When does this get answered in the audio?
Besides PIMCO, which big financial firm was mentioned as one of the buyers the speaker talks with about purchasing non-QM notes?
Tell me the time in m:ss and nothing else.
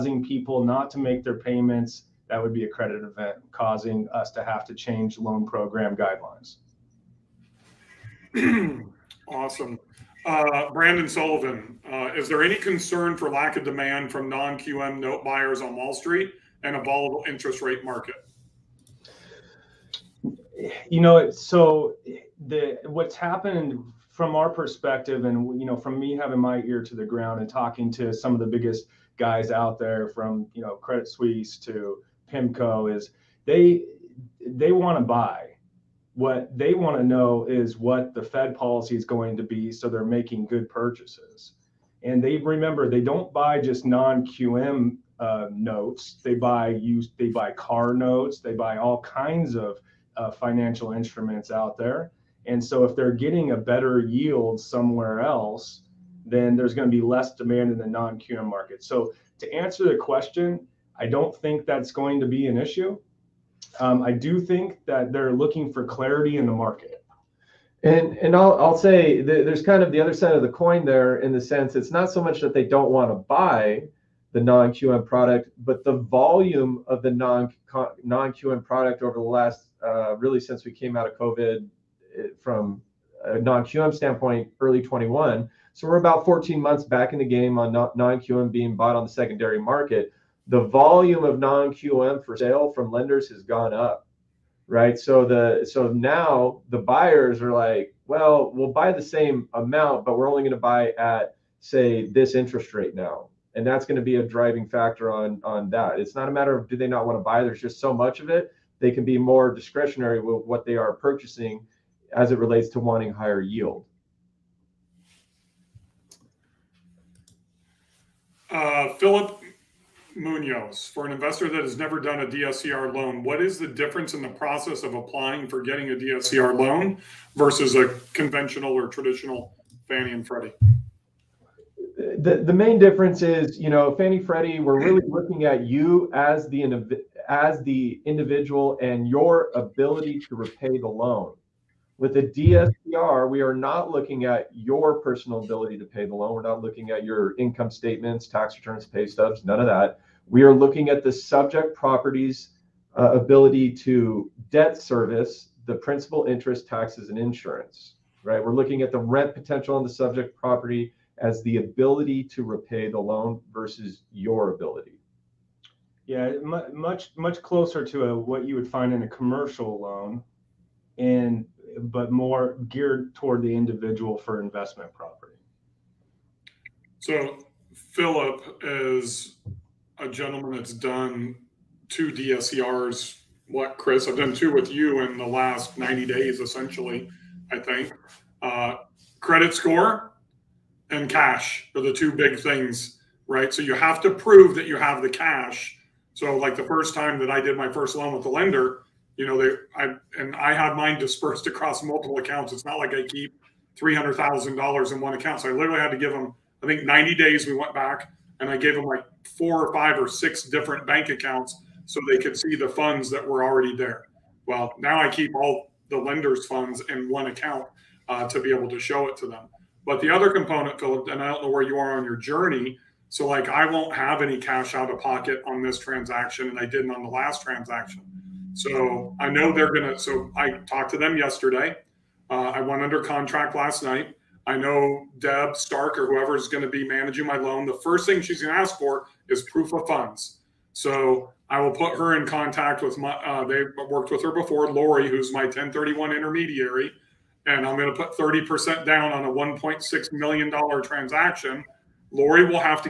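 0:30.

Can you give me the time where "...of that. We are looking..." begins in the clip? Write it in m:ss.
2:29.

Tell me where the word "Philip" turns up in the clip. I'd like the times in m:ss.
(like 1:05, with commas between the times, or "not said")
1:58, 2:57, 3:40.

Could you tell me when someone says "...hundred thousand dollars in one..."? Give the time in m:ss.
3:23.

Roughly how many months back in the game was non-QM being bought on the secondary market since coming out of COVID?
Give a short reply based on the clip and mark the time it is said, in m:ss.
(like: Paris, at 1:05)
14 months, at 1:26.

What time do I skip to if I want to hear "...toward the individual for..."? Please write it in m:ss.
2:53.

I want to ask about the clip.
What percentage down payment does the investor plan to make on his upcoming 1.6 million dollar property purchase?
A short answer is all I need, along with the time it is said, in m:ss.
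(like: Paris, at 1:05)
30%, at 4:08.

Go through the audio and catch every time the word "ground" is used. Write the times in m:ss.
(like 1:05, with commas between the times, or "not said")
0:27.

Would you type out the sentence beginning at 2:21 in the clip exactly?
With a DSCR, we are not looking at your personal ability to pay the loan.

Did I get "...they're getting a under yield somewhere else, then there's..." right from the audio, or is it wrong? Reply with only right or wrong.
wrong.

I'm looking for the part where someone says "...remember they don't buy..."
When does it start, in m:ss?
0:42.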